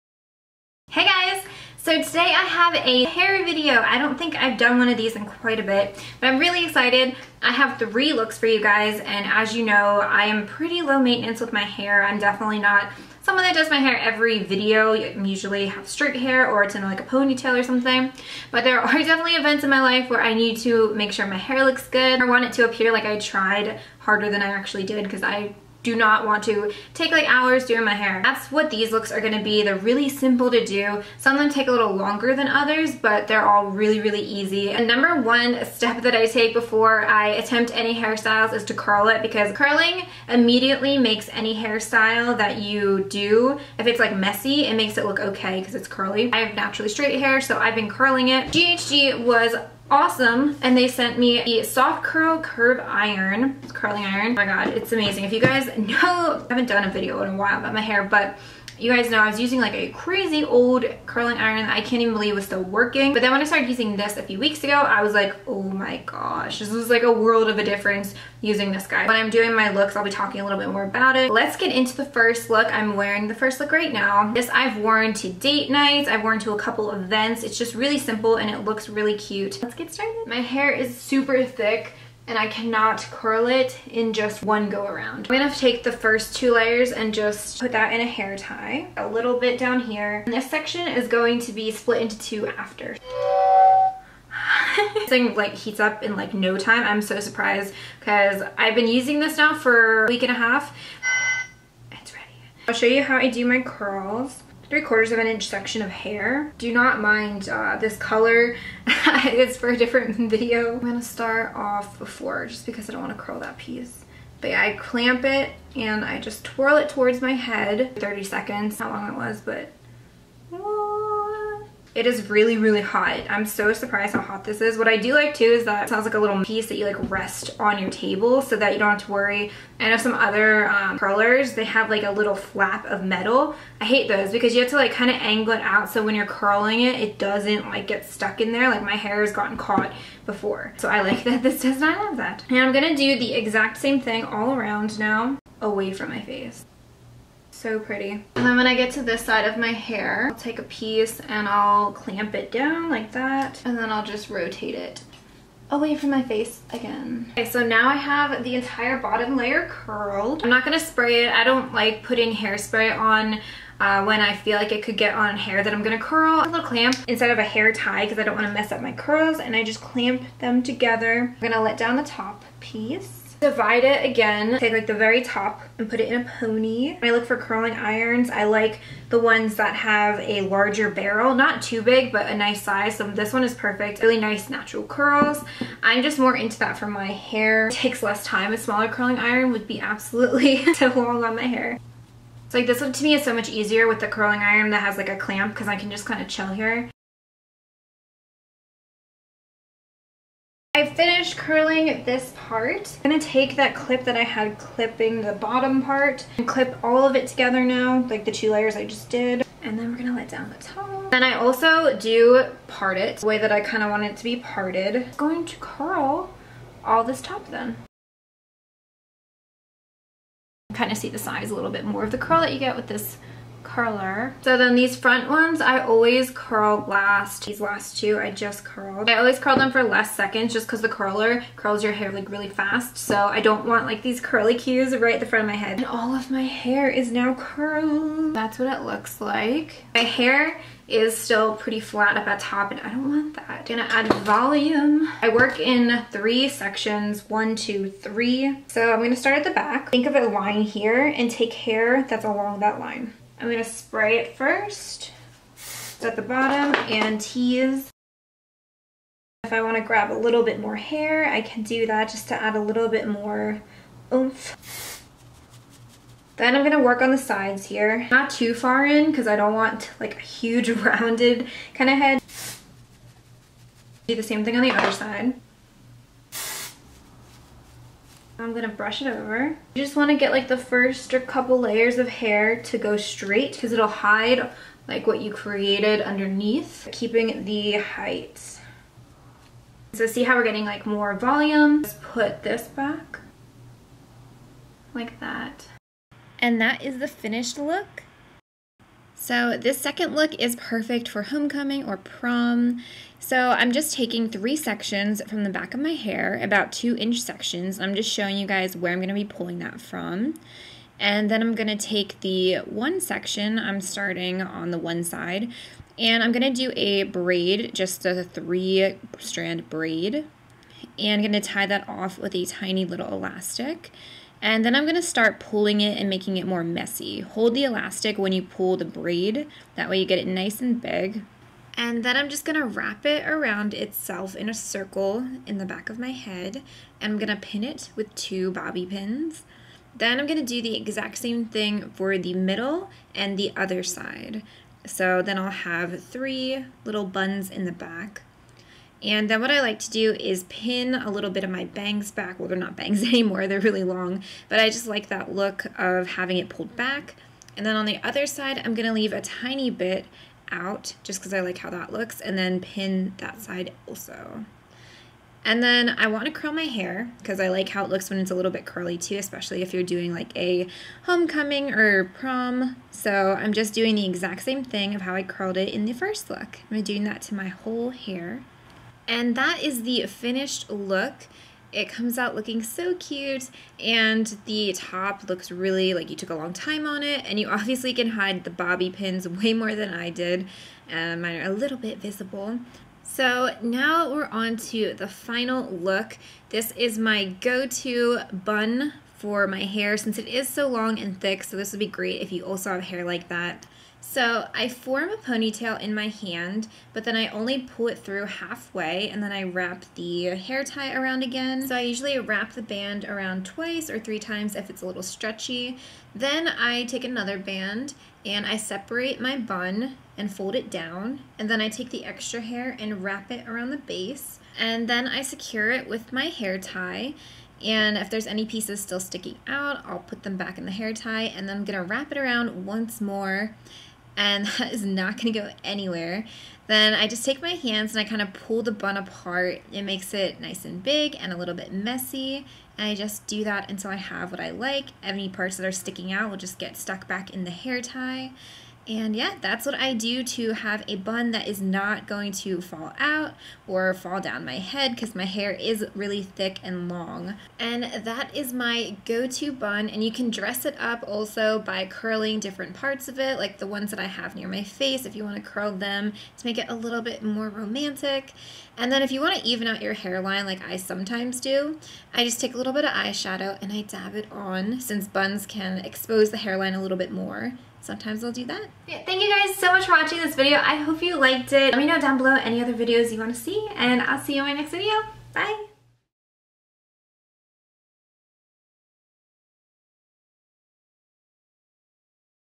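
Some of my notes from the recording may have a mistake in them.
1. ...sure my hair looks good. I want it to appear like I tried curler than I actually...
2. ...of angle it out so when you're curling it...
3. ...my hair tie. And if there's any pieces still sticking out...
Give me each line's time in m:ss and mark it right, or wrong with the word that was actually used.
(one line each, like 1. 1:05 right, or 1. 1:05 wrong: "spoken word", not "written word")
1. 0:21 wrong: "harder", not "curler"
2. 2:15 right
3. 7:06 right.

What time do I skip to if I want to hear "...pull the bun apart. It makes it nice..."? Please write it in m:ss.
7:18.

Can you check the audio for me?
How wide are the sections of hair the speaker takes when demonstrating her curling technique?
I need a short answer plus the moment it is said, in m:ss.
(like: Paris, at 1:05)
3/4 of an inch, at 1:44.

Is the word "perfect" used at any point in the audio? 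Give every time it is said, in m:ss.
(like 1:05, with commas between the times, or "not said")
3:03, 5:00.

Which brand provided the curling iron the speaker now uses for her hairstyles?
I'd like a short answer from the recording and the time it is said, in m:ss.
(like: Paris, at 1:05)
GHD, at 0:48.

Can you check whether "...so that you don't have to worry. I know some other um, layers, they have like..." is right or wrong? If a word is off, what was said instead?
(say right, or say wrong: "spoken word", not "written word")
wrong: "curlers", not "layers".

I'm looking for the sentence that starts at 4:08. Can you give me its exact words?
So I'm gonna start at the back.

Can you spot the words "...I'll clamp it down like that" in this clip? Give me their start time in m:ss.
2:31.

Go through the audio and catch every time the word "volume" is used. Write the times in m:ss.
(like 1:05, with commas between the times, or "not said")
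4:04, 4:51.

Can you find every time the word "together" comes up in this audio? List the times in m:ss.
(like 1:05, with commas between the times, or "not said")
2:50, 3:27.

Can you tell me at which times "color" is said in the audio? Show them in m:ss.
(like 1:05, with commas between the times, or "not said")
1:47.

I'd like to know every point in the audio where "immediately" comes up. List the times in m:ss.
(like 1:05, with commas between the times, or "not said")
0:40.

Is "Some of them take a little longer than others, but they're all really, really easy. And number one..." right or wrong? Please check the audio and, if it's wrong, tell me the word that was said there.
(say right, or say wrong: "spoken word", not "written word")
right.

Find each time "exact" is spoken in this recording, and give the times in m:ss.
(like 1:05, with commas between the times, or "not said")
2:23, 5:40, 6:14.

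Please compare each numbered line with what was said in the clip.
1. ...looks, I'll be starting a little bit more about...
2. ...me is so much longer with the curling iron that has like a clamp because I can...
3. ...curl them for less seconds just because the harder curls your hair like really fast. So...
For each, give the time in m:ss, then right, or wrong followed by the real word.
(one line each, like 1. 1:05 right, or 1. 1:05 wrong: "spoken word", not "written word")
1. 1:09 wrong: "talking", not "starting"
2. 3:13 wrong: "easier", not "longer"
3. 3:49 wrong: "curler", not "harder".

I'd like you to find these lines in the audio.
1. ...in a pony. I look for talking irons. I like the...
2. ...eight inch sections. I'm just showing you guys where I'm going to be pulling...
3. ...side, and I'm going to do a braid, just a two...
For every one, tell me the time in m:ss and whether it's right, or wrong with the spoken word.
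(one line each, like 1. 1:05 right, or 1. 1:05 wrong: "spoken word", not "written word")
1. 2:56 wrong: "curling", not "talking"
2. 5:06 wrong: "two", not "eight"
3. 5:15 wrong: "three", not "two".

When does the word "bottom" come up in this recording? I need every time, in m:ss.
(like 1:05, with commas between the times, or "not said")
2:38, 3:25, 4:16.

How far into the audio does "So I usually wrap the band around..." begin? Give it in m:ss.
6:51.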